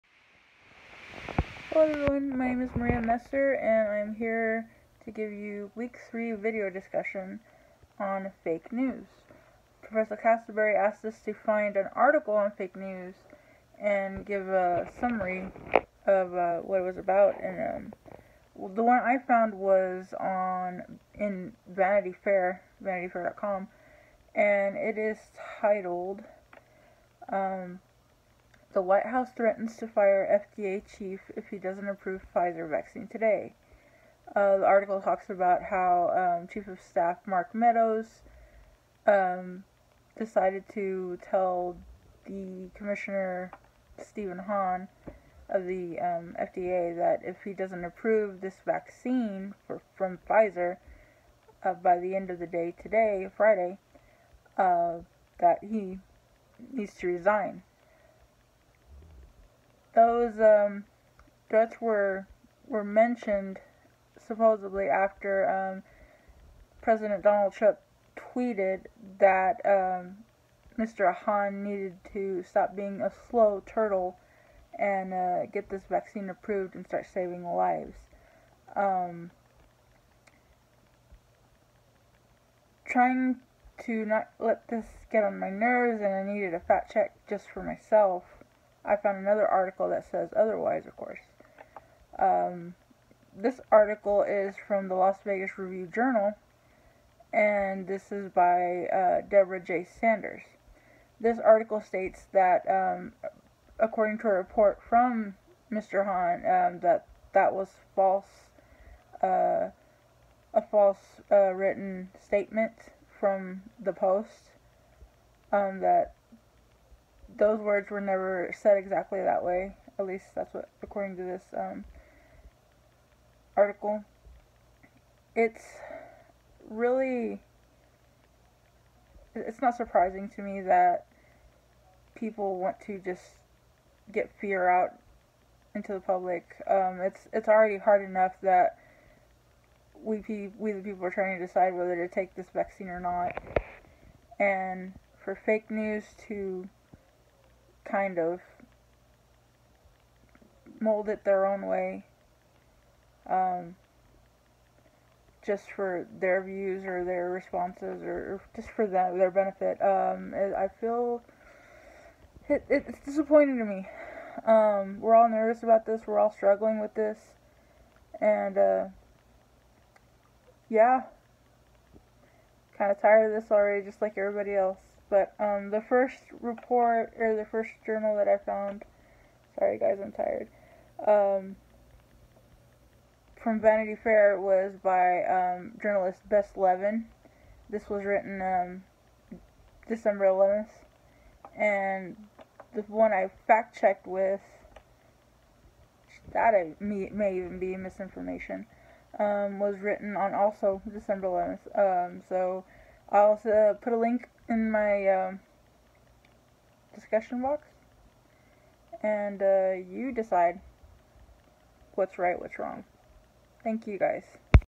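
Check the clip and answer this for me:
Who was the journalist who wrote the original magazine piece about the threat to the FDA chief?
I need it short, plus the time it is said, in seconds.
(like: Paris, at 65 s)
Bess Levin, at 186 s.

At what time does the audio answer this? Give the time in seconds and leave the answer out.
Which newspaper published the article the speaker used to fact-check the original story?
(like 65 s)
94 s.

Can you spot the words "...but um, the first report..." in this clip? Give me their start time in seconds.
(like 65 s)
175 s.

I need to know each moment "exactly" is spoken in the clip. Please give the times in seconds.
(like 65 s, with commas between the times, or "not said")
118 s.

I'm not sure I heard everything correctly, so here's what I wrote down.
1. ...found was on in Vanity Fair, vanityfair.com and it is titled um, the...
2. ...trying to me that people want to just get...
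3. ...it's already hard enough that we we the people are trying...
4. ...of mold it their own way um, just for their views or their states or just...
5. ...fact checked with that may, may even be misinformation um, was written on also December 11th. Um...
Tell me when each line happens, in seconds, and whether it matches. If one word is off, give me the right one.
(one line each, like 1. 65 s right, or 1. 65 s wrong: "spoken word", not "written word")
1. 19 s right
2. 129 s wrong: "surprising", not "trying"
3. 137 s right
4. 148 s wrong: "responses", not "states"
5. 193 s right.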